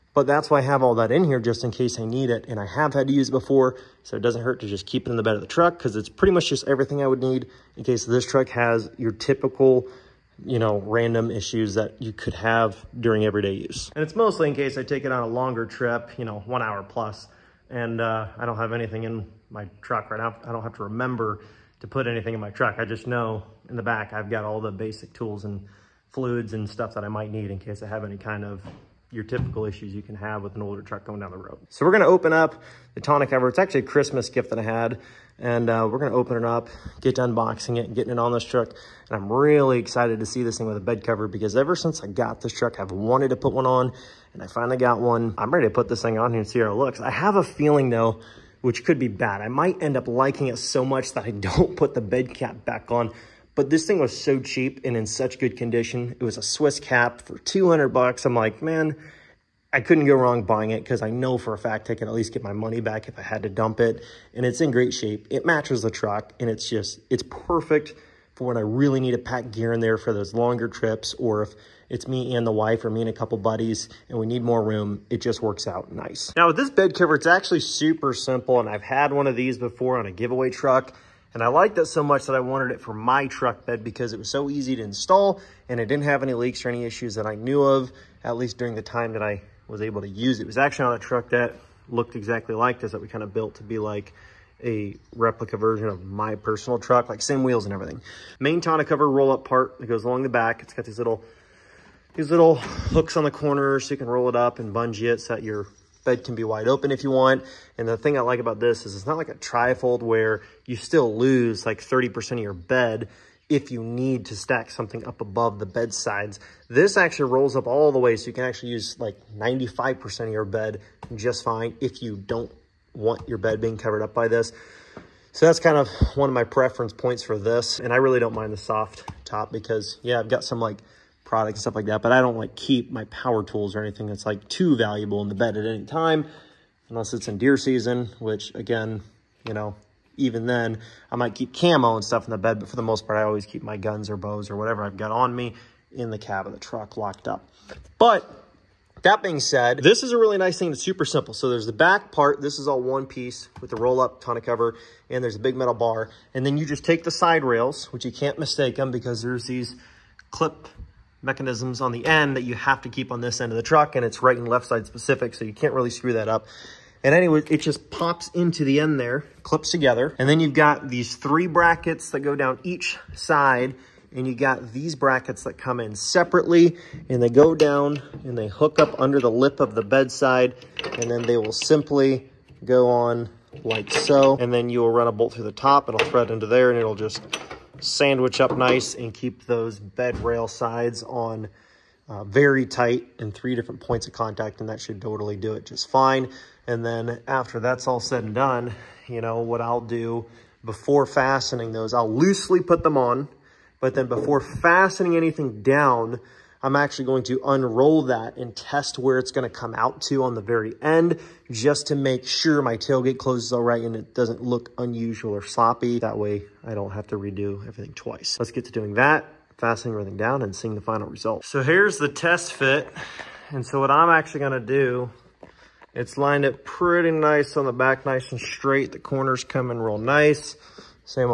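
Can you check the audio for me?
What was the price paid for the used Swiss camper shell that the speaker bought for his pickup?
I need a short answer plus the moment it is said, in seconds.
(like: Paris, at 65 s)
$200, at 57 s.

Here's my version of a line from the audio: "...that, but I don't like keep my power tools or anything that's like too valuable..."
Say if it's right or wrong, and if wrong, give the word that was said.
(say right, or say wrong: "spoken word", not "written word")
right.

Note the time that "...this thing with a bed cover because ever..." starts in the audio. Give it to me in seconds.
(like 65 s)
40 s.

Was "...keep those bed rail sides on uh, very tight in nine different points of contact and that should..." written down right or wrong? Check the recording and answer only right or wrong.
wrong.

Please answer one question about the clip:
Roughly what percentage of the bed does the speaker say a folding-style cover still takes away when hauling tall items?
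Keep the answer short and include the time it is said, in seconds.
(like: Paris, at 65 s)
30%, at 111 s.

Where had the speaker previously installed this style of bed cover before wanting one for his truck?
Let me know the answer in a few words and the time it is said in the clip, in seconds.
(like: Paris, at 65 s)
On a giveaway truck, at 80 s.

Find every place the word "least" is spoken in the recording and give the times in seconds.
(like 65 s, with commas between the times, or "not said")
62 s, 88 s.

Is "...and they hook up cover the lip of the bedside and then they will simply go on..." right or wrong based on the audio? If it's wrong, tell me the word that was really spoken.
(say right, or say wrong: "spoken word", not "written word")
wrong: "under", not "cover".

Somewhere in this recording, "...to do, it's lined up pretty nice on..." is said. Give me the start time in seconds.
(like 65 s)
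224 s.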